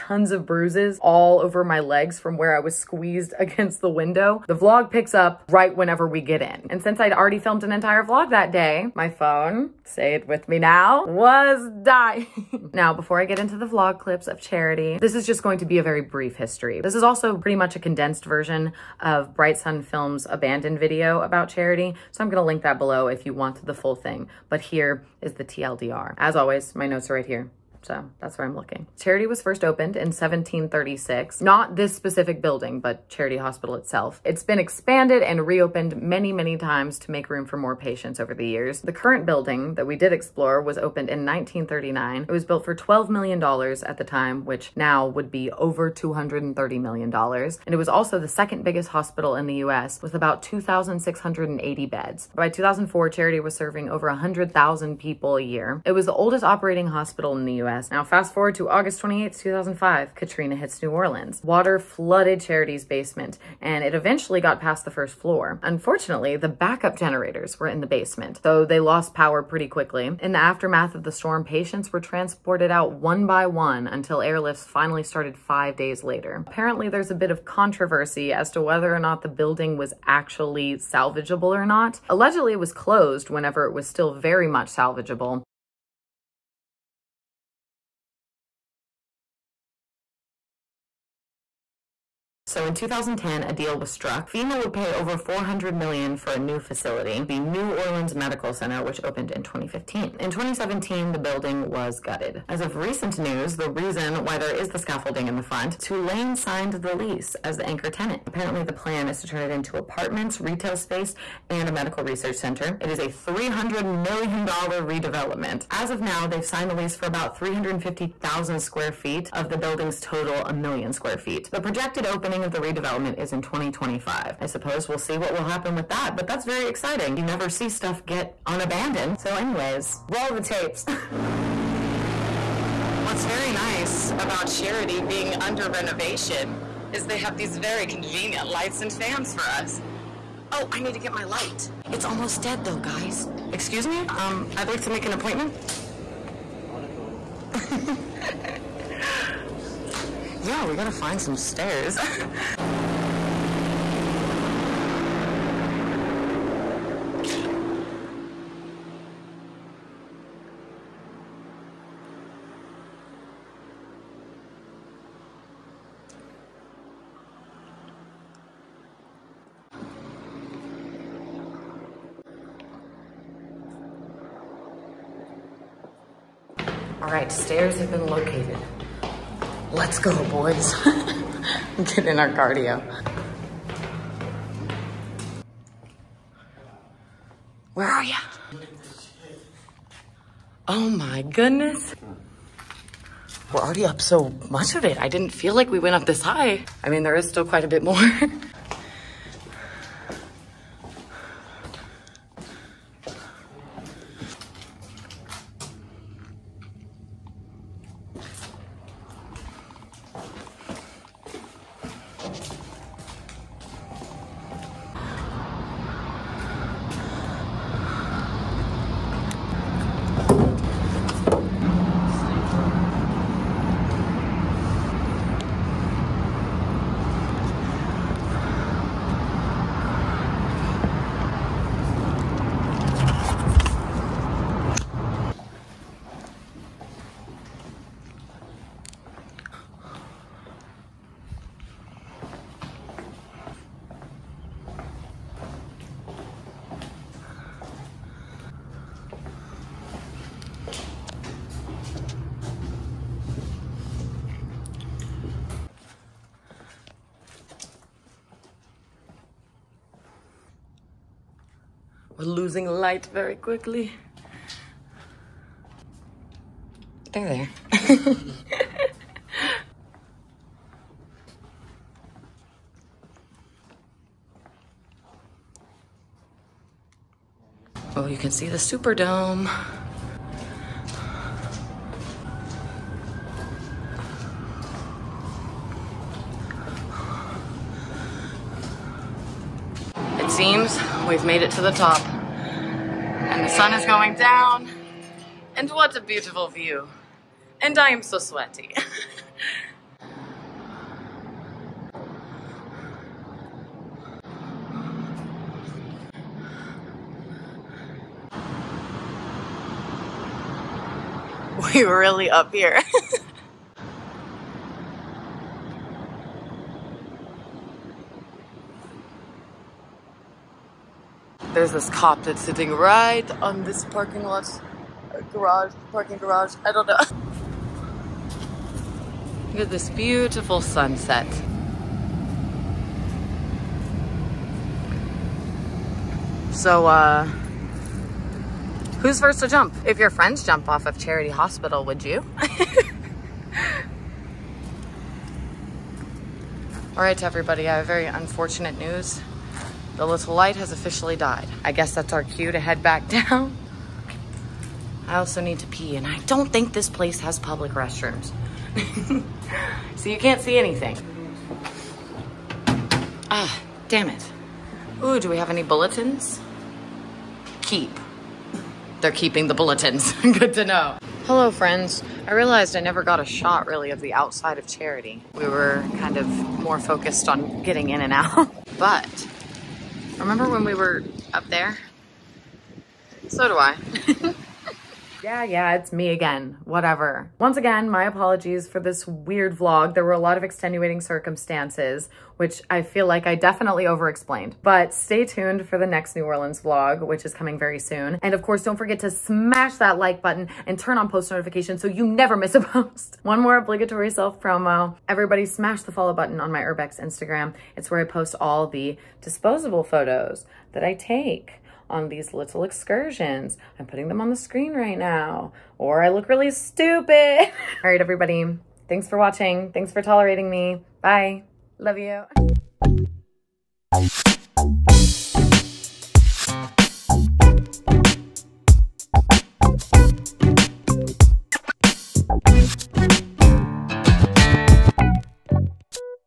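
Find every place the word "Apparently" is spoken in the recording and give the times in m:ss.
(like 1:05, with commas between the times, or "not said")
1:16, 1:48.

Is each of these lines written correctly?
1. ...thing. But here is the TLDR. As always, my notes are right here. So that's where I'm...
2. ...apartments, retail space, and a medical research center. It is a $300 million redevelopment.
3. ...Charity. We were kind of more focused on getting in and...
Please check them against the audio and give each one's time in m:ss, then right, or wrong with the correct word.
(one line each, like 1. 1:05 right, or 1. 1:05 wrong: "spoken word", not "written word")
1. 0:23 right
2. 1:49 right
3. 6:14 right.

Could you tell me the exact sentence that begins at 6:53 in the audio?
I'm putting them on the screen right now, or I look really stupid.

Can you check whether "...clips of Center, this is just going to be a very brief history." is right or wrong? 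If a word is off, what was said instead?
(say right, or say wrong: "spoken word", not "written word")
wrong: "Charity", not "Center".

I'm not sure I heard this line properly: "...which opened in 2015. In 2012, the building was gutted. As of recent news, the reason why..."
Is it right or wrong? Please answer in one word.
wrong.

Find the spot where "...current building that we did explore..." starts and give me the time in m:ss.
0:38.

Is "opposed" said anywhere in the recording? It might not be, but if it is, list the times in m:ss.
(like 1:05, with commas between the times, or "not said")
not said.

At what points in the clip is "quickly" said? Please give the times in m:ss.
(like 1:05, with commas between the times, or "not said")
1:09, 4:23.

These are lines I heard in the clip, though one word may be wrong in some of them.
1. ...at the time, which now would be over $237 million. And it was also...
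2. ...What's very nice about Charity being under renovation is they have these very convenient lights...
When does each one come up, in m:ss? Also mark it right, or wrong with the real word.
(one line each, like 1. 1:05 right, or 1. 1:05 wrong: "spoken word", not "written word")
1. 0:43 wrong: "230", not "237"
2. 2:13 right.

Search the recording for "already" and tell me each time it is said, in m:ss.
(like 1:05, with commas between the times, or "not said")
0:07, 3:13.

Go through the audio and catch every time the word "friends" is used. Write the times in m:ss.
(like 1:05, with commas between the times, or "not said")
5:40, 6:11.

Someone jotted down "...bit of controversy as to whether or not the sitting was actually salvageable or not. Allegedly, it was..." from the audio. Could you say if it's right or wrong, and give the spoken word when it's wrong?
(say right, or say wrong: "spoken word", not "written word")
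wrong: "building", not "sitting".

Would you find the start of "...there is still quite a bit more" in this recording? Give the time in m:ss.
3:17.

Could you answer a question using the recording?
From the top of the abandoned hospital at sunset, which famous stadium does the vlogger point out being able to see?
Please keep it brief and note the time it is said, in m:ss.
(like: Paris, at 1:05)
the Superdome, at 4:38.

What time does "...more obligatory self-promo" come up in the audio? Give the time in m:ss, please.
6:43.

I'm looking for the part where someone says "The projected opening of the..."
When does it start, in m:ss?
2:01.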